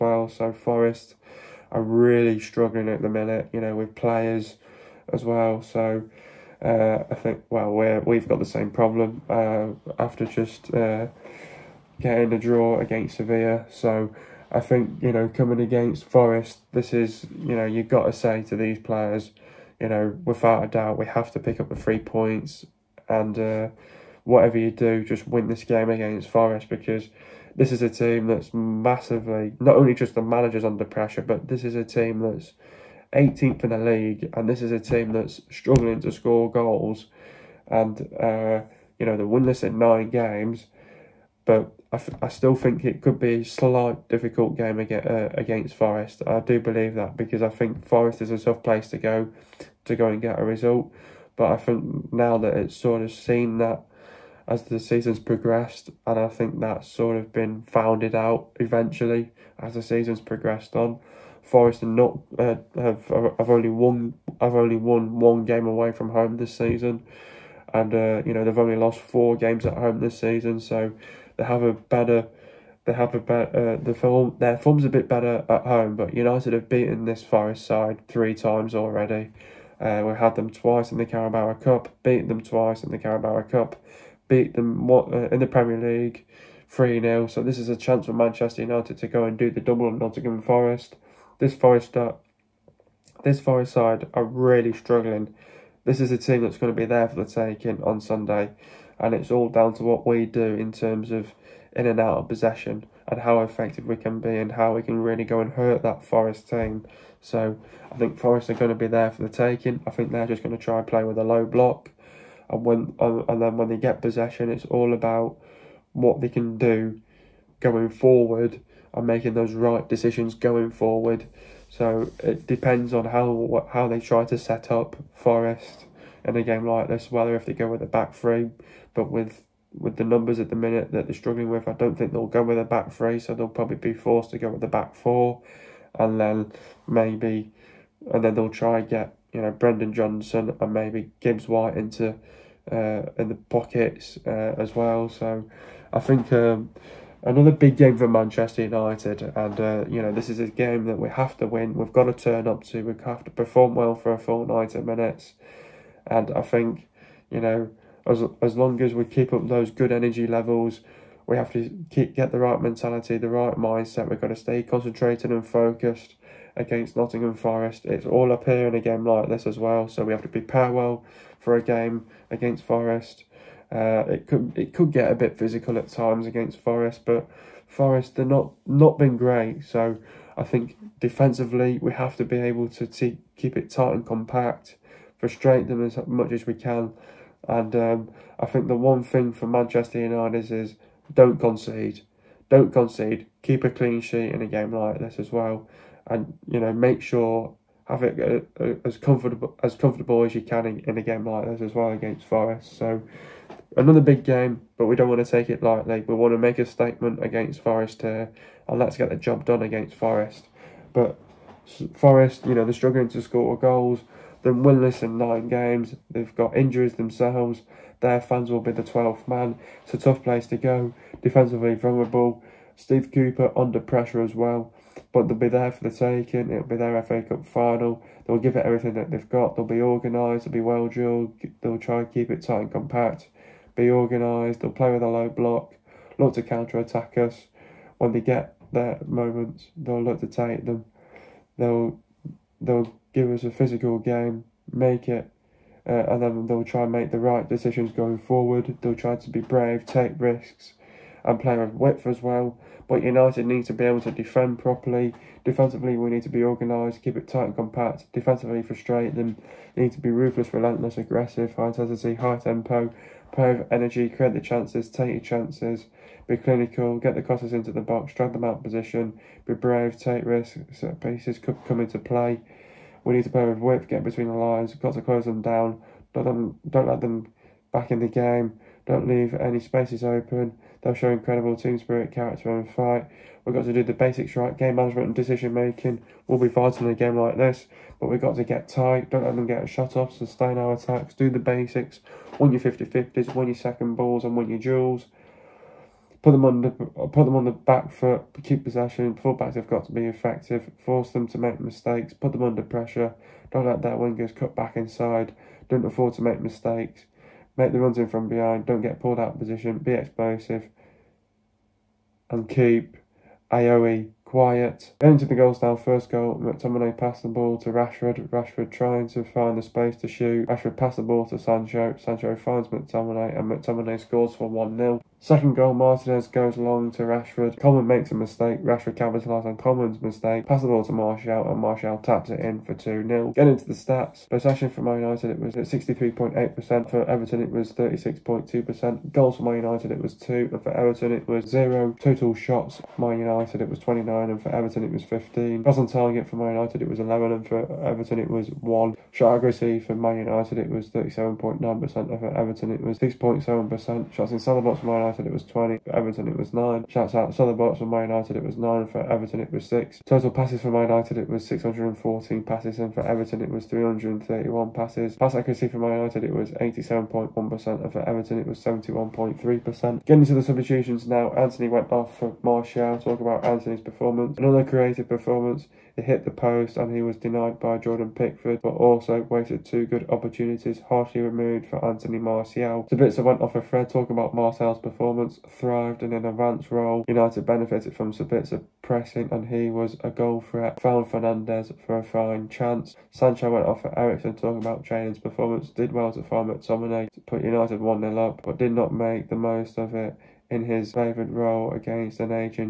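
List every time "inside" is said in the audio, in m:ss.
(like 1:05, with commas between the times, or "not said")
5:04, 5:54.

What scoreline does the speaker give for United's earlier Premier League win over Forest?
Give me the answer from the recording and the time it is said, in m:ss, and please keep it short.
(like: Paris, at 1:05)
3-0, at 1:26.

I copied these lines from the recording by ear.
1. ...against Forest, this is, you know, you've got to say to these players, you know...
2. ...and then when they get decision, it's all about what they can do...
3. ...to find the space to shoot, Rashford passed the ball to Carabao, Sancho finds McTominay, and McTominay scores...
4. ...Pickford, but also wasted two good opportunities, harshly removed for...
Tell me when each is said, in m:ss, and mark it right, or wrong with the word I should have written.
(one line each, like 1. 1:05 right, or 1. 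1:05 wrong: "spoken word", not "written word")
1. 0:15 right
2. 1:53 wrong: "possession", not "decision"
3. 5:19 wrong: "Sancho", not "Carabao"
4. 6:18 right.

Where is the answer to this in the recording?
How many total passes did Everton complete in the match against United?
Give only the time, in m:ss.
6:03.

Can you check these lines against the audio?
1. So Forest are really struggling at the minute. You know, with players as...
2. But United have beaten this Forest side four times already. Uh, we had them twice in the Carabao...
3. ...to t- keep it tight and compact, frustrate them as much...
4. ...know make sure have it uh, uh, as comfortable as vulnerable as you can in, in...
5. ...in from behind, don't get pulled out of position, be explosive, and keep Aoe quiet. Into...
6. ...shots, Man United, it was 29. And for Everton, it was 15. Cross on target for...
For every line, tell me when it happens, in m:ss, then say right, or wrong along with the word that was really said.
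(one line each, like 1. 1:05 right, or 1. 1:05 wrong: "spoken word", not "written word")
1. 0:00 right
2. 1:15 wrong: "three", not "four"
3. 3:02 right
4. 3:16 wrong: "comfortable", not "vulnerable"
5. 5:07 right
6. 5:42 right.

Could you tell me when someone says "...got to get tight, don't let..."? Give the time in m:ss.
4:48.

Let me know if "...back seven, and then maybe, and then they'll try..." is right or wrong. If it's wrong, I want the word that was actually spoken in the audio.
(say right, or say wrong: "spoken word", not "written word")
wrong: "four", not "seven".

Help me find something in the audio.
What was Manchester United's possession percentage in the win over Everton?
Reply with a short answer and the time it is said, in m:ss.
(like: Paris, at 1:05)
63.8%, at 5:35.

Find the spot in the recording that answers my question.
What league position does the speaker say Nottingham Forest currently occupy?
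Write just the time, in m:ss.
0:33.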